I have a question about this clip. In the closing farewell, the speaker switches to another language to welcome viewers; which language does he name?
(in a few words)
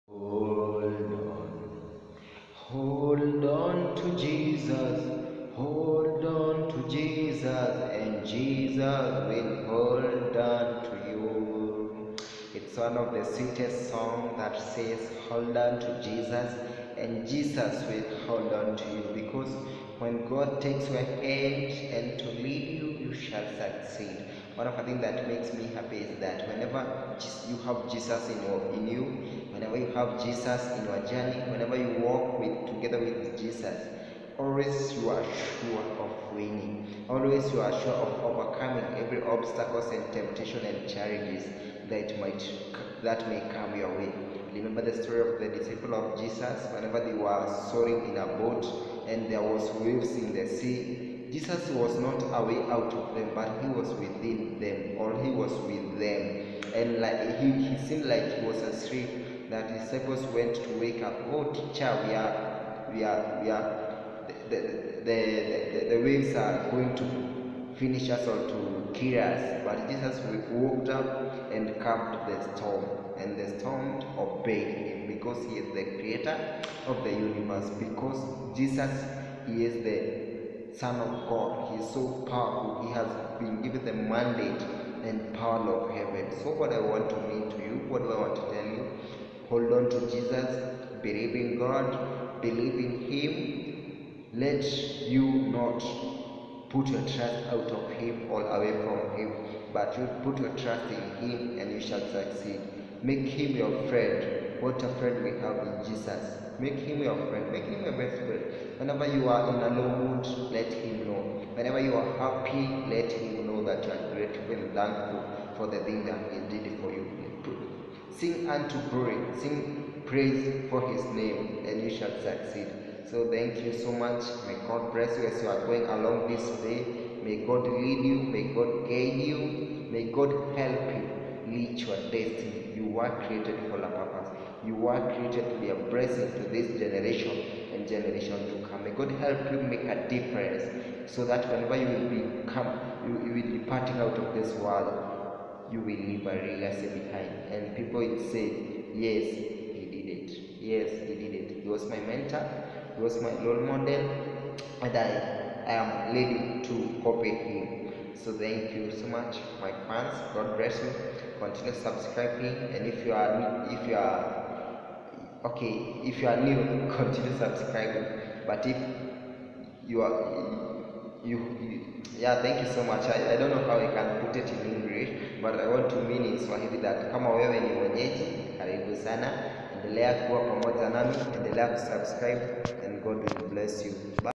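Swahili.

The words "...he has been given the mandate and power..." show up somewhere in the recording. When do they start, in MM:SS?
01:22.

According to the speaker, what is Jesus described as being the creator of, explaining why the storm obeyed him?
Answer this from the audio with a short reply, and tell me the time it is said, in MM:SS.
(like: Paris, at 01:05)
The universe, at 01:17.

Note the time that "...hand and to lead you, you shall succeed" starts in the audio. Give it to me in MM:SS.
00:21.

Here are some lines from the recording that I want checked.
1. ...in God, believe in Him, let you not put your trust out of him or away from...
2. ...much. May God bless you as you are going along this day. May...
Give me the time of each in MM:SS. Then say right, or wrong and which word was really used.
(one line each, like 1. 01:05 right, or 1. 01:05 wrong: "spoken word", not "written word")
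1. 01:31 right
2. 02:03 right.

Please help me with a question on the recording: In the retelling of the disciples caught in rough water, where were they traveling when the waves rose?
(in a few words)
In a boat.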